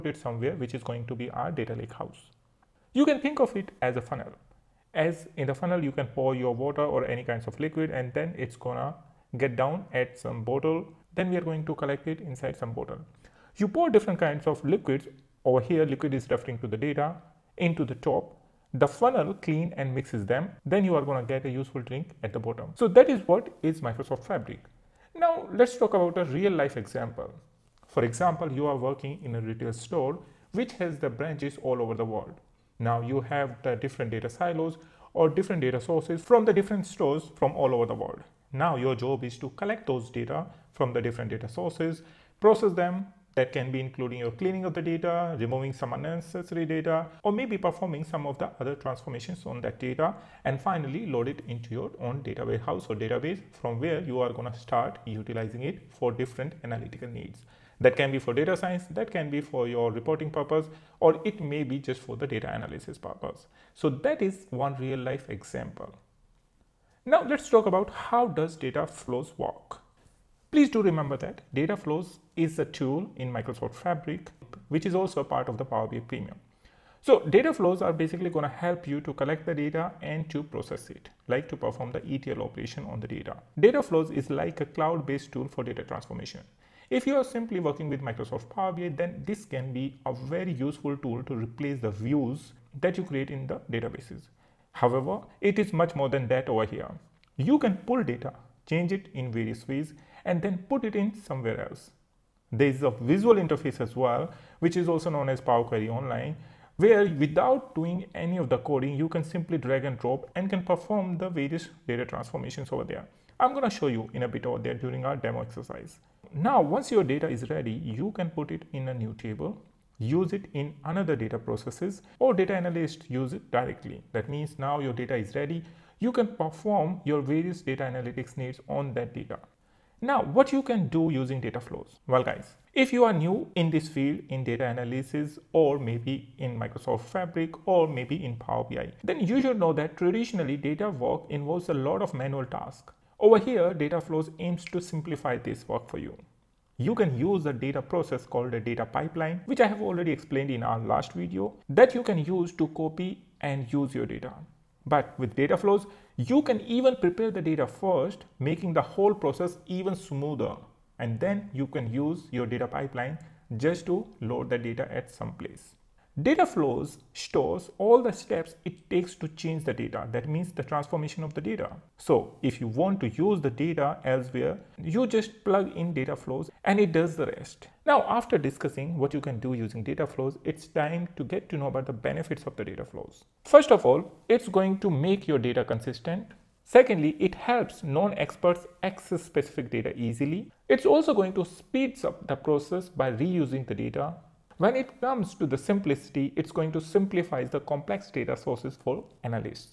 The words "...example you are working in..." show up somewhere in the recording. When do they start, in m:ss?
0:28.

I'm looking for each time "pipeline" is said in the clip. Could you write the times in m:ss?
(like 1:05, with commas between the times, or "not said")
2:28, 2:42.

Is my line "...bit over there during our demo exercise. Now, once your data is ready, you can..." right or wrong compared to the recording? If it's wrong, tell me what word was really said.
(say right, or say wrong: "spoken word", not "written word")
right.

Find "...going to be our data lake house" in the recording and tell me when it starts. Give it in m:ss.
0:00.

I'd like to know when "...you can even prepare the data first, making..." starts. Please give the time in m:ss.
2:36.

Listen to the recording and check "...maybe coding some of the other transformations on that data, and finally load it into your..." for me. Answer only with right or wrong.
wrong.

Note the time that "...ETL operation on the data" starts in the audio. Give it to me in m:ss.
1:22.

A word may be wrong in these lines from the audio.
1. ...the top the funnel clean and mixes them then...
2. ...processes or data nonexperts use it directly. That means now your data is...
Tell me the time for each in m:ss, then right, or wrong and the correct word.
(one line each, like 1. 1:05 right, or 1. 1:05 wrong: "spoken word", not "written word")
1. 0:17 right
2. 2:01 wrong: "analysts", not "nonexperts".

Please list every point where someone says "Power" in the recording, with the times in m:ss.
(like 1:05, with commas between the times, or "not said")
1:15, 1:28, 1:45, 2:18.